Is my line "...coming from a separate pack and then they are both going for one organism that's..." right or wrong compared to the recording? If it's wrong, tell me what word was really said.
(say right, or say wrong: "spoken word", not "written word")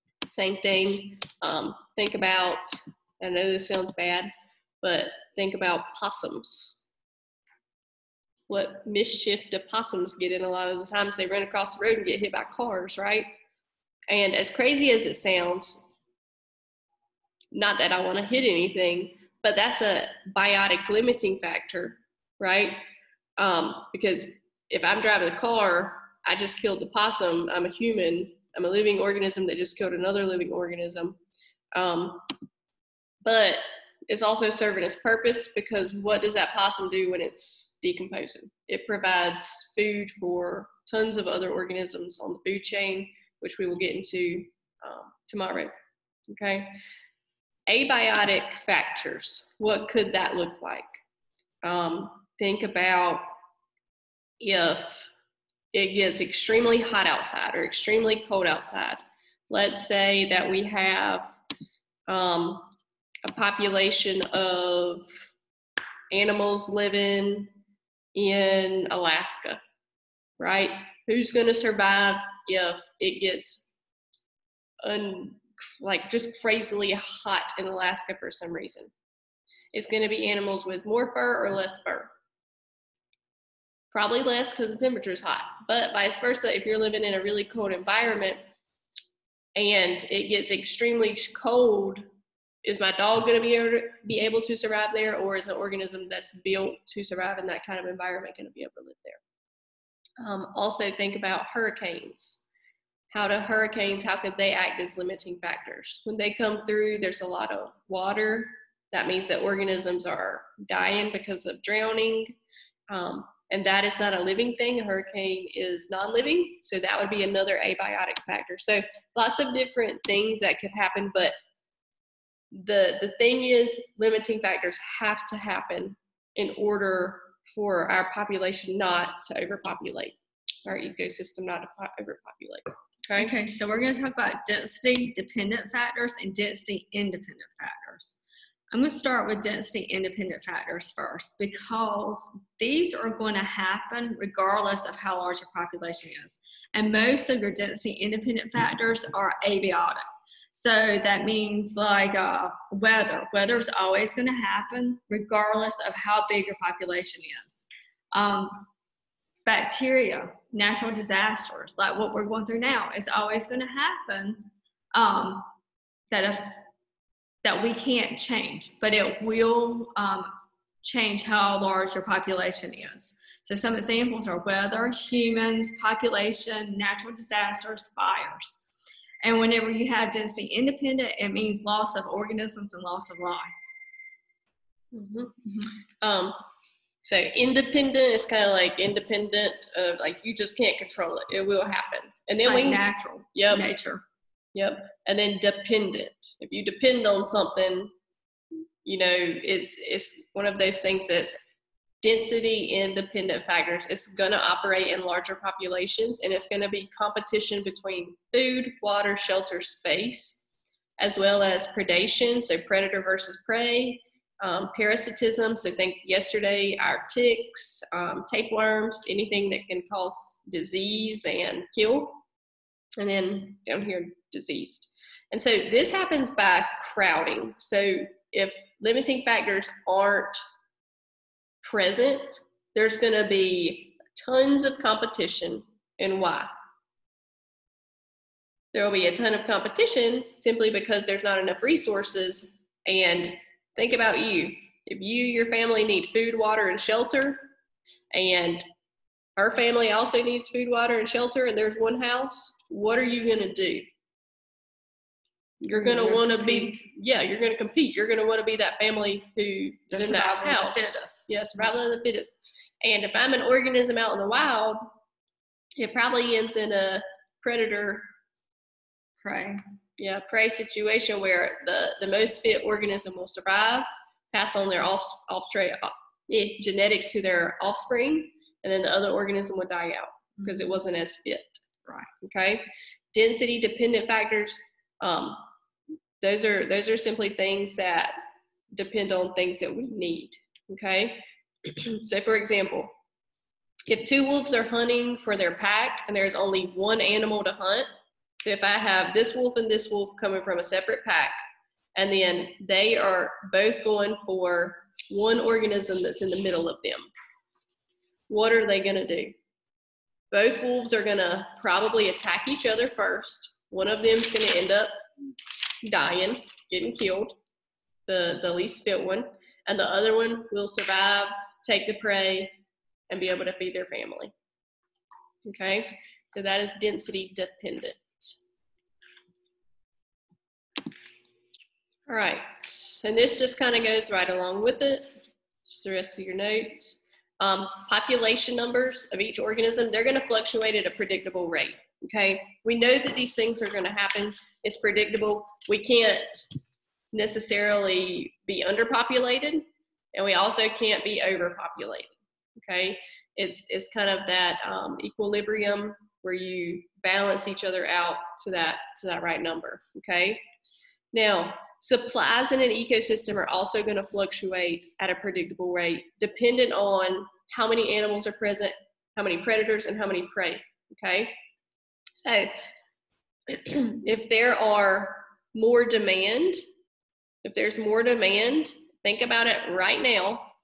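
right.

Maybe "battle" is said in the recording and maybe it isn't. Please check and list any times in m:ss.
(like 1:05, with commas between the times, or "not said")
not said.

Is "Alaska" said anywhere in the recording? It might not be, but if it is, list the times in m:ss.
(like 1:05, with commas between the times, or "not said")
1:08, 1:17.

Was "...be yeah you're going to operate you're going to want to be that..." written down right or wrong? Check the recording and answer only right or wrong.
wrong.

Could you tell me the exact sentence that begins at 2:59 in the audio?
And whenever you have density independent, it means loss of organisms and loss of life.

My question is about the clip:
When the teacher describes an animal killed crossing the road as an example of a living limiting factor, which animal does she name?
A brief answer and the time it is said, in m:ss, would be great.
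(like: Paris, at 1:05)
Possums, at 0:05.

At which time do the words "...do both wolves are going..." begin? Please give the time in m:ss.
5:09.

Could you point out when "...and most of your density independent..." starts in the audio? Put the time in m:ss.
2:26.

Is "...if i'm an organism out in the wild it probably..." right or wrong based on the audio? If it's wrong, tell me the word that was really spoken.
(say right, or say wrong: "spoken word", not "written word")
right.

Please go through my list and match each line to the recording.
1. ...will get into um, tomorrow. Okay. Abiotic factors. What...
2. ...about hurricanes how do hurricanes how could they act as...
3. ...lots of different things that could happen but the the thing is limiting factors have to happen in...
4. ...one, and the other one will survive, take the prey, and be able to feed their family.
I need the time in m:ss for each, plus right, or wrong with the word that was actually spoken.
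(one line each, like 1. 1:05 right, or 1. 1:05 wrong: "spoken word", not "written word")
1. 0:43 right
2. 1:41 right
3. 1:59 right
4. 5:19 right.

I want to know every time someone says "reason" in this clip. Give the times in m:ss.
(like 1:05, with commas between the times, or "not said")
1:18.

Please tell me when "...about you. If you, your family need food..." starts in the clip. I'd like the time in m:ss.
4:03.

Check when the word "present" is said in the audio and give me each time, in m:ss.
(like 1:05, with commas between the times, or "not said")
3:51, 6:08.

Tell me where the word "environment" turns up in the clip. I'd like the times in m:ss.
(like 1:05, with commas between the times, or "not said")
1:27, 1:37.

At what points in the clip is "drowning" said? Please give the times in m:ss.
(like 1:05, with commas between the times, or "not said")
1:51.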